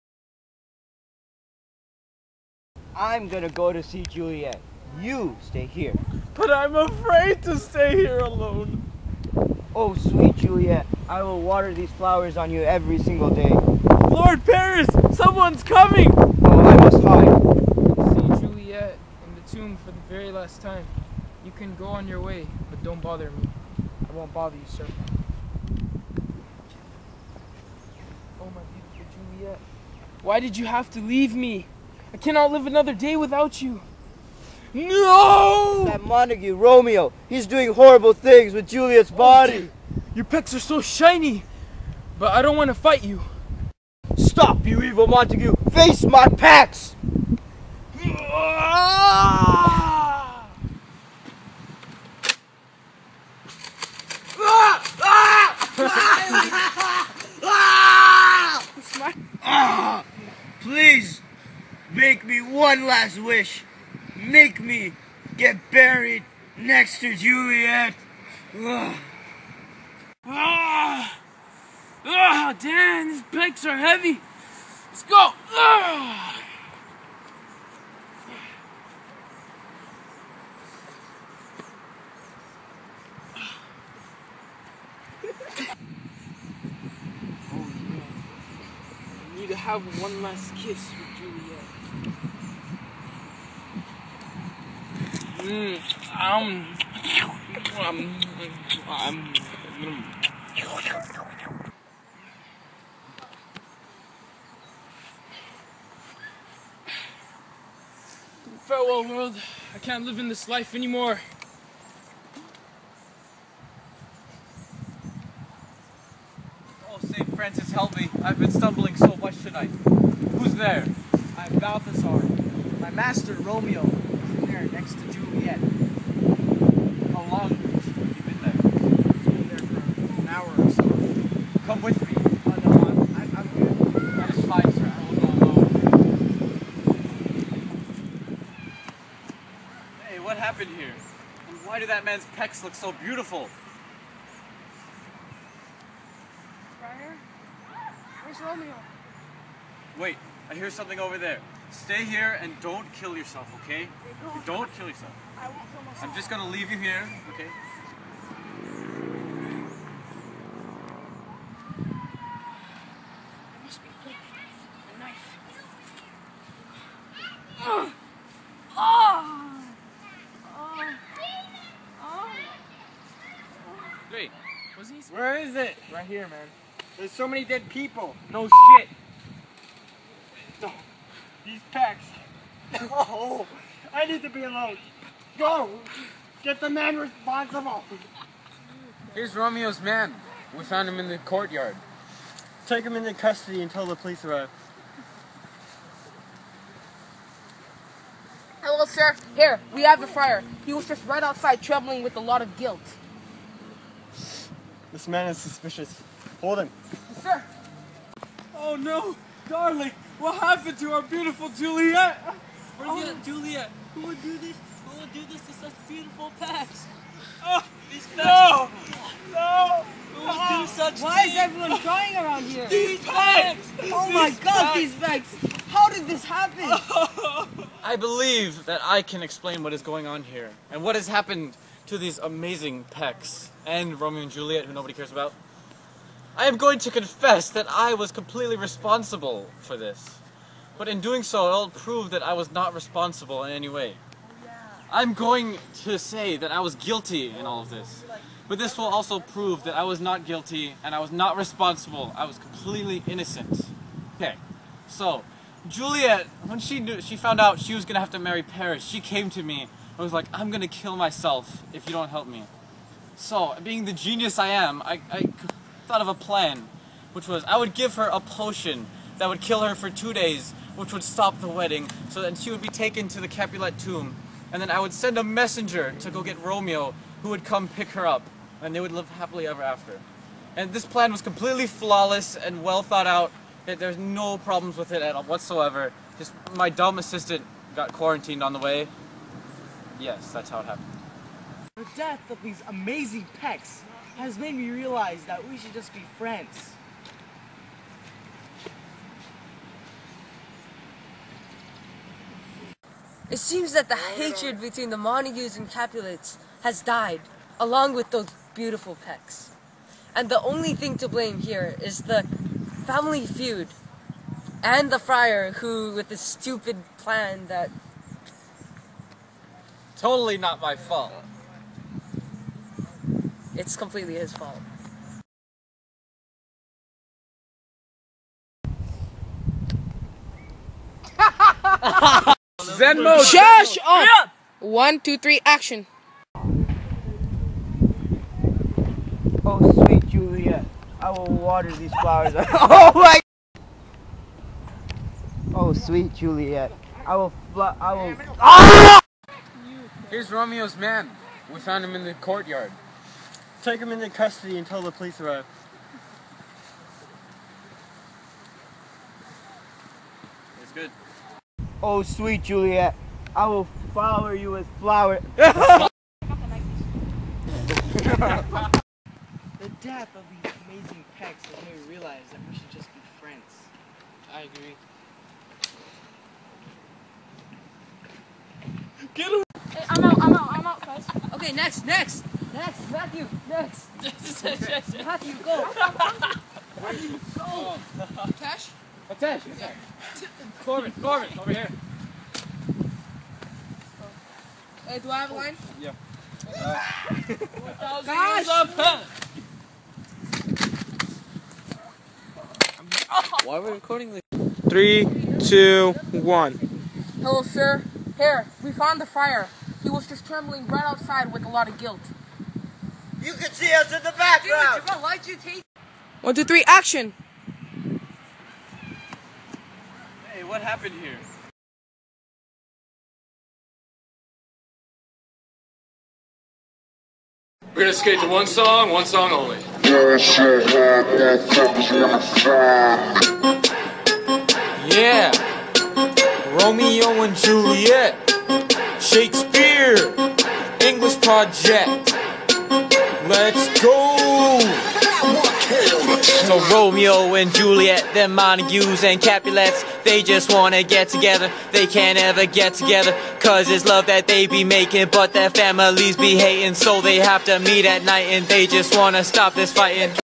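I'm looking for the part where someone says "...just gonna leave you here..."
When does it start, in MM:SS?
02:36.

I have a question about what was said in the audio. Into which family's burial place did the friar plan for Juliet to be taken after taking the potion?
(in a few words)
Capulet tomb.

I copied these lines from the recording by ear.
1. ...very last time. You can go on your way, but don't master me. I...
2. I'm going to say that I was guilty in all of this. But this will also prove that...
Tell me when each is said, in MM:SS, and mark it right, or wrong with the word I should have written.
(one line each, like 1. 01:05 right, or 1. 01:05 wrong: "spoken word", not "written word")
1. 00:20 wrong: "bother", not "master"
2. 04:04 right.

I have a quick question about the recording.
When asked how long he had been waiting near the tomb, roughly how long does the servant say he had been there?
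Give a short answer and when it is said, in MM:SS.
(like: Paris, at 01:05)
an hour or so, at 02:10.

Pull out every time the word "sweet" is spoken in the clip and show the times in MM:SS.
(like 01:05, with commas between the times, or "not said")
00:09, 05:39, 05:45, 06:02.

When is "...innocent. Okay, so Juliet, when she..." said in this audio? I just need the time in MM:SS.
04:13.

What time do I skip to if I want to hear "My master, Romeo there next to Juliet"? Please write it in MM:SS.
02:02.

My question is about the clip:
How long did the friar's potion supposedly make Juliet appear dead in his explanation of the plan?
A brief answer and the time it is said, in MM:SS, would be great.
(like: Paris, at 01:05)
2 days, at 04:29.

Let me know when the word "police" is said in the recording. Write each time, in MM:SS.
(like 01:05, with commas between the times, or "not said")
03:13, 05:54.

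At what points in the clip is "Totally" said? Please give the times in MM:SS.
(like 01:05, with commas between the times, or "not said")
05:19.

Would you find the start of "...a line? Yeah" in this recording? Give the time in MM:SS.
06:35.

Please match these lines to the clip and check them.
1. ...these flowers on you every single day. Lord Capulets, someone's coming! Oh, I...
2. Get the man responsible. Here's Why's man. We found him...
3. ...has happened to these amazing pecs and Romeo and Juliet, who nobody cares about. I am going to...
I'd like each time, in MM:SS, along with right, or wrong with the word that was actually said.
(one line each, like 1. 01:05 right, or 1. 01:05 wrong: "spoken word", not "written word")
1. 00:11 wrong: "Paris", not "Capulets"
2. 03:06 wrong: "Romeo", not "Why"
3. 03:50 right.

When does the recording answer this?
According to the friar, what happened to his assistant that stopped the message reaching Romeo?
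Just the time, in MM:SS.
04:47.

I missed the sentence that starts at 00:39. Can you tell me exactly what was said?
Oh, your pecs are so shiny, but I don't want to fight you.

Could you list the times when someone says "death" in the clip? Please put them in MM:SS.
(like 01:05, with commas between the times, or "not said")
04:51, 06:09.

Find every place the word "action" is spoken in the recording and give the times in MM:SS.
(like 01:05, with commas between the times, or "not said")
05:35, 06:56.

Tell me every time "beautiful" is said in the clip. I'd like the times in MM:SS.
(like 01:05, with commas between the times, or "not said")
00:28, 02:22, 03:31, 03:35, 05:08.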